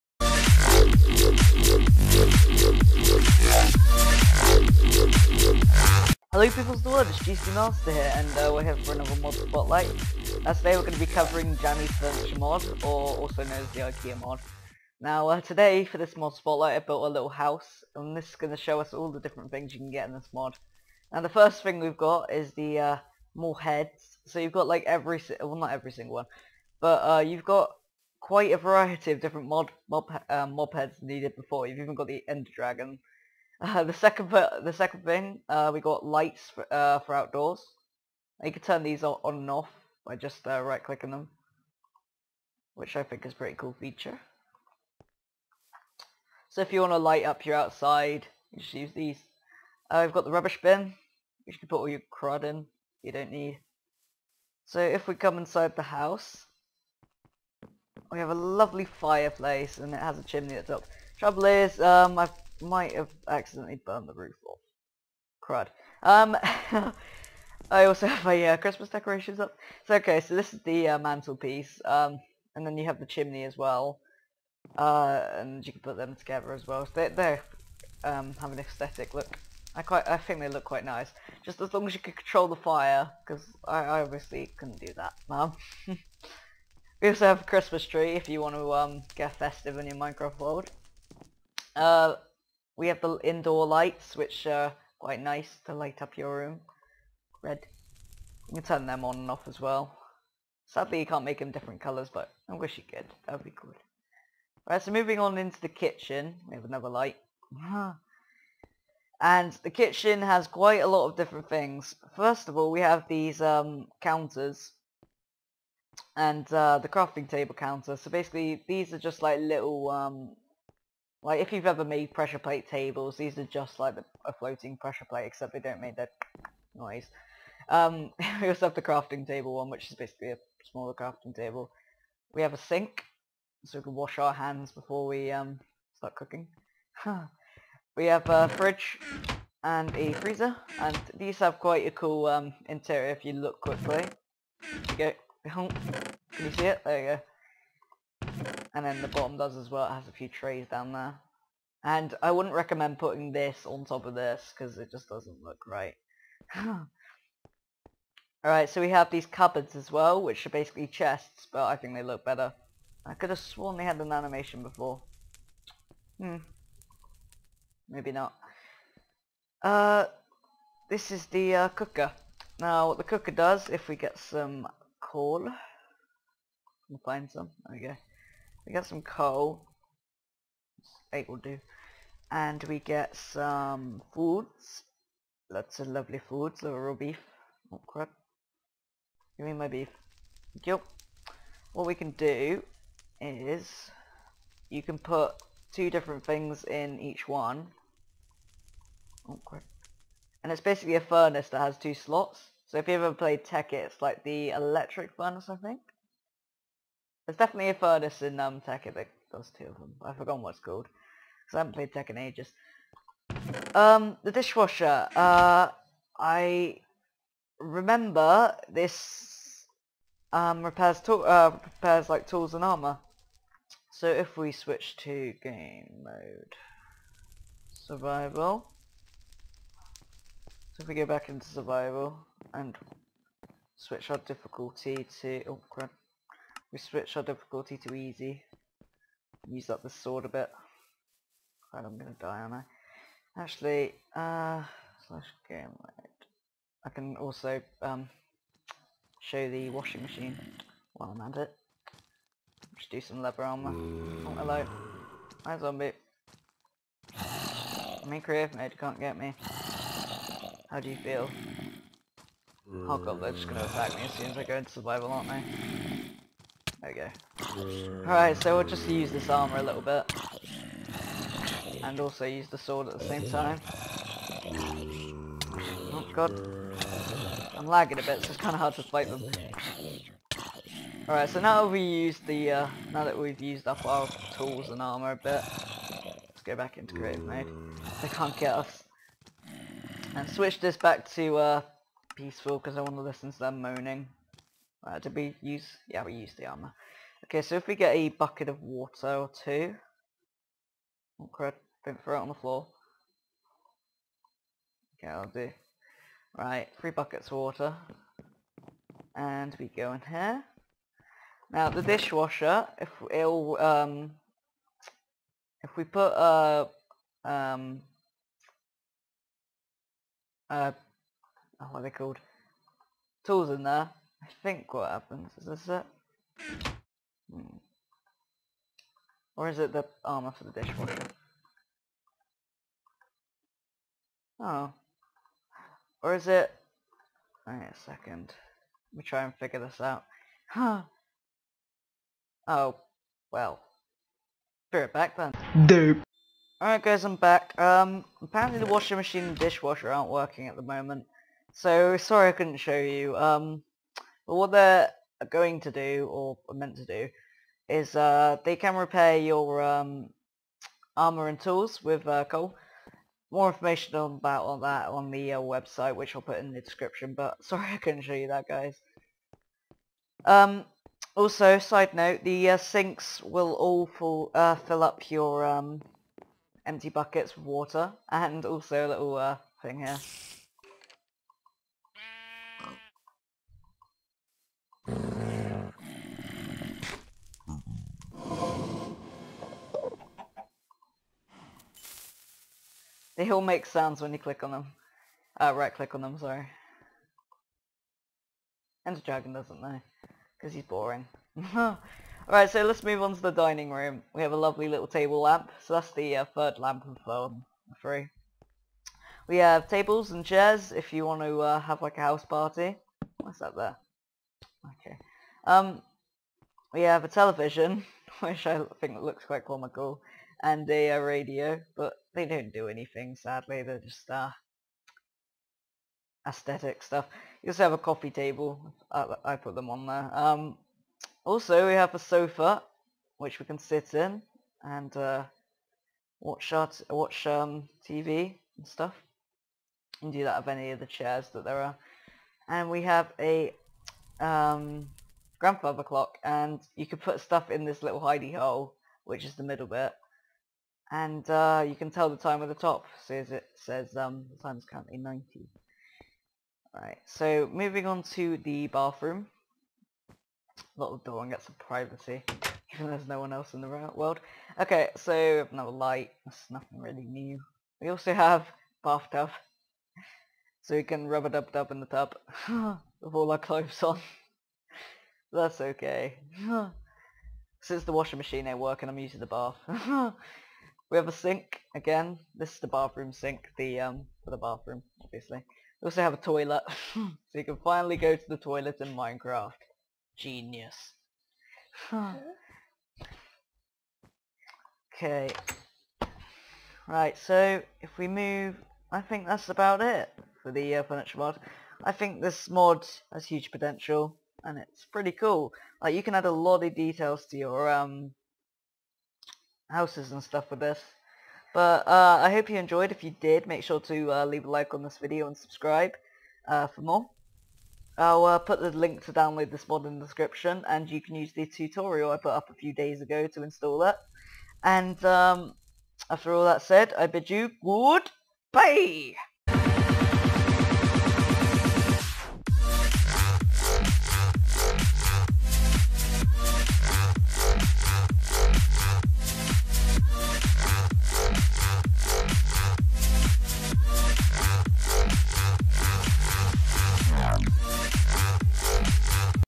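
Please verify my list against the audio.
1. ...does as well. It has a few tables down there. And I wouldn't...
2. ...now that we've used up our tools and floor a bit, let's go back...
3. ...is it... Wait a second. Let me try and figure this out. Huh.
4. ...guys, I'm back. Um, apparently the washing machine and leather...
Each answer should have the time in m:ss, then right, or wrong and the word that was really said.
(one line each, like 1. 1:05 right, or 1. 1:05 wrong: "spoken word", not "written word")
1. 2:29 wrong: "trees", not "tables"
2. 4:42 wrong: "armor", not "floor"
3. 5:36 right
4. 5:46 wrong: "dishwasher", not "leather".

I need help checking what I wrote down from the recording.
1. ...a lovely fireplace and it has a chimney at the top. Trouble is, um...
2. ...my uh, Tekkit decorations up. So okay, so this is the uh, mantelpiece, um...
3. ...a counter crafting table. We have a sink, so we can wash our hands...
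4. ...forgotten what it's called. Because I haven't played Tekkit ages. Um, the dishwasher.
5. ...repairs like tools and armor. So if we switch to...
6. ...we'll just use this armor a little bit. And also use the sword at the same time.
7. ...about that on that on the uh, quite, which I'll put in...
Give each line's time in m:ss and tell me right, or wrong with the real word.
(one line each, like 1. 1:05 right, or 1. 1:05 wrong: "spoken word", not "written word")
1. 0:58 right
2. 1:08 wrong: "Christmas", not "Tekkit"
3. 2:10 wrong: "smaller", not "counter"
4. 3:30 right
5. 3:41 right
6. 4:28 right
7. 6:03 wrong: "website", not "quite".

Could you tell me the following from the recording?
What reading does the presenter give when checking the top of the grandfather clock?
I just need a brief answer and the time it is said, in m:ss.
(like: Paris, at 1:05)
90, at 7:34.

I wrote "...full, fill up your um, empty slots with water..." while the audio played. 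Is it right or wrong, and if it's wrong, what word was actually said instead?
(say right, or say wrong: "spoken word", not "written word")
wrong: "buckets", not "slots".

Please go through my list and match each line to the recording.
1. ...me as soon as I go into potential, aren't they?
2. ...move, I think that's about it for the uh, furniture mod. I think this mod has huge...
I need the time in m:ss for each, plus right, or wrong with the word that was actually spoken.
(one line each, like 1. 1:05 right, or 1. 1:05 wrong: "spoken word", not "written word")
1. 4:23 wrong: "survival", not "potential"
2. 8:18 right.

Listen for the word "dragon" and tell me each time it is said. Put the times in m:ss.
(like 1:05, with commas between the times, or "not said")
0:32, 6:39.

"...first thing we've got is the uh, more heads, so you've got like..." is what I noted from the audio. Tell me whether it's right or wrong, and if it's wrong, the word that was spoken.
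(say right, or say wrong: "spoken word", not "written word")
right.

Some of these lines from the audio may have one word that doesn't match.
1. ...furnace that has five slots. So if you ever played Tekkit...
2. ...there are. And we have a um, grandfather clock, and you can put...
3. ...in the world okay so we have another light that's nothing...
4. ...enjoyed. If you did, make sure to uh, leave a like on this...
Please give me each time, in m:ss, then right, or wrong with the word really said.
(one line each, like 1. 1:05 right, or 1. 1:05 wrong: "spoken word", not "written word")
1. 3:21 wrong: "two", not "five"
2. 7:21 right
3. 7:43 right
4. 8:32 right.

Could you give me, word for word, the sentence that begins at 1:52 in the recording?
First of all, we have these um, counters.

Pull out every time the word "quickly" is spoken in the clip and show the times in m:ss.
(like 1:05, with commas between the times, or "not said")
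2:23.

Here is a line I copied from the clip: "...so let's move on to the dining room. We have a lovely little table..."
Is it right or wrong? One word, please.
right.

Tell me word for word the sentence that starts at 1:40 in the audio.
Sadly, you can't make them different colours, but I wish you could.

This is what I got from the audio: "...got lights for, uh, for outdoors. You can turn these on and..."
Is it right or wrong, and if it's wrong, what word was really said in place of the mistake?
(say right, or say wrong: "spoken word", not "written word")
right.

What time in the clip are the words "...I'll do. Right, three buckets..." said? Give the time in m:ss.
5:05.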